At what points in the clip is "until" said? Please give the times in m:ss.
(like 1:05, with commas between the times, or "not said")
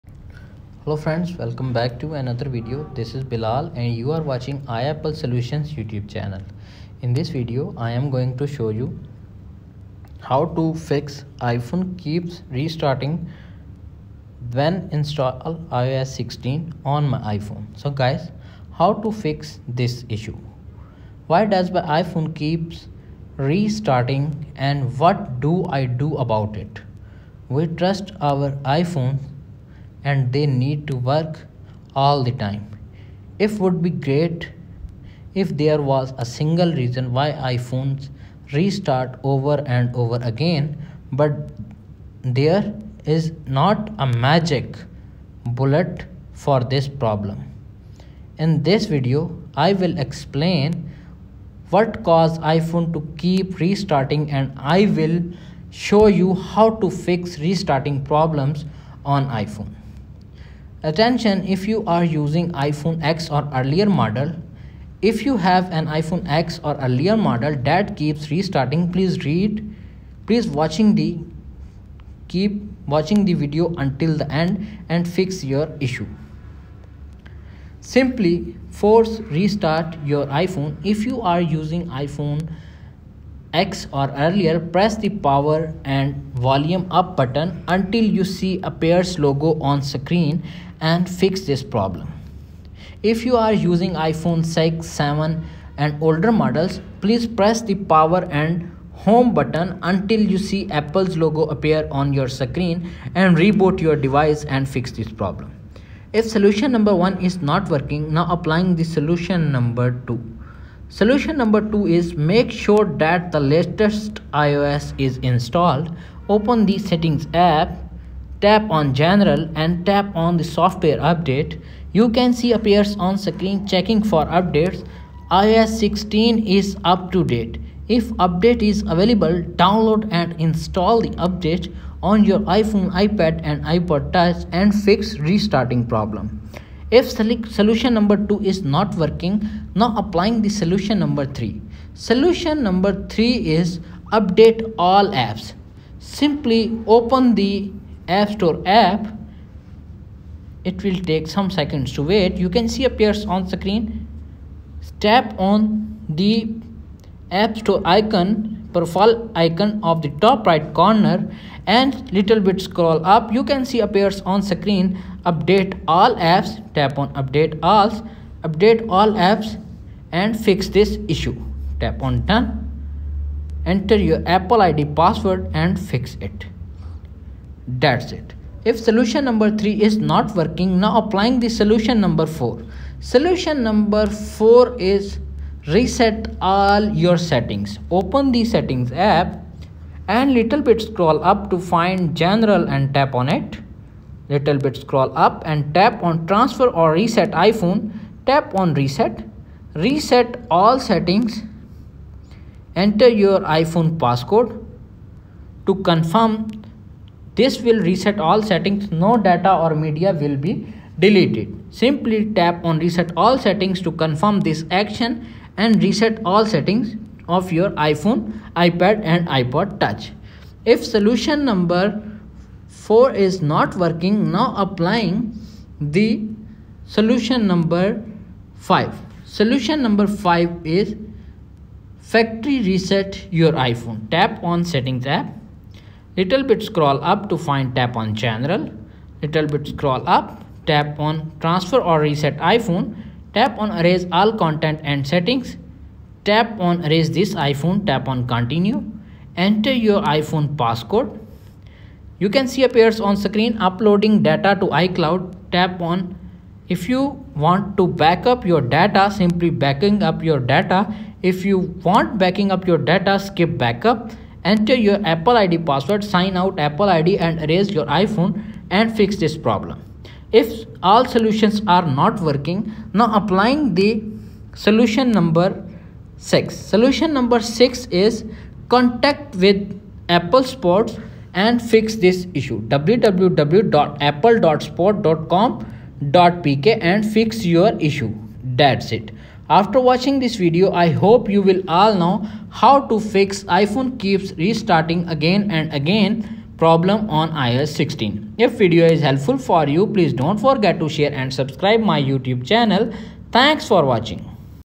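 1:13, 1:27, 1:39.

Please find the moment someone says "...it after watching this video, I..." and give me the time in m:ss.
4:48.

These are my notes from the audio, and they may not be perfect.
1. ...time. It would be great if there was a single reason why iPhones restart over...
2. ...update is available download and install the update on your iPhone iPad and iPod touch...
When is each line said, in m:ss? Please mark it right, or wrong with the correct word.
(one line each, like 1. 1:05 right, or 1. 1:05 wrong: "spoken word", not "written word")
1. 0:32 right
2. 2:08 right.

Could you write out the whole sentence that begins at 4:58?
If video is helpful for you, please don't forget to share and subscribe my YouTube channel.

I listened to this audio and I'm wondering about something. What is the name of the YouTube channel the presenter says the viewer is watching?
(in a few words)
iapple solutions.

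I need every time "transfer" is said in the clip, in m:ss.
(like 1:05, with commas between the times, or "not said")
3:16, 4:01.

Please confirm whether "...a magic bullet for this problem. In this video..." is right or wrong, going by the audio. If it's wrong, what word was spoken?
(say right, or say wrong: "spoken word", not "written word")
right.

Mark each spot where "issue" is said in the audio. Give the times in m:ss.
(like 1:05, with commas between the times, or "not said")
0:20, 1:15, 2:51, 4:42, 4:47.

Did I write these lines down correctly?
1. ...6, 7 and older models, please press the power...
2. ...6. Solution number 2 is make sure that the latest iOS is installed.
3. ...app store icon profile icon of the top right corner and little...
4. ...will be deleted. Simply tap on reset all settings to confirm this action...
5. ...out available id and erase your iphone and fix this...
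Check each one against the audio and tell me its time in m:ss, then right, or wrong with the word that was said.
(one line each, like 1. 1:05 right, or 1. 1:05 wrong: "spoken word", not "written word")
1. 1:34 right
2. 1:50 wrong: "2", not "6"
3. 2:37 right
4. 3:30 right
5. 4:26 wrong: "apple", not "available".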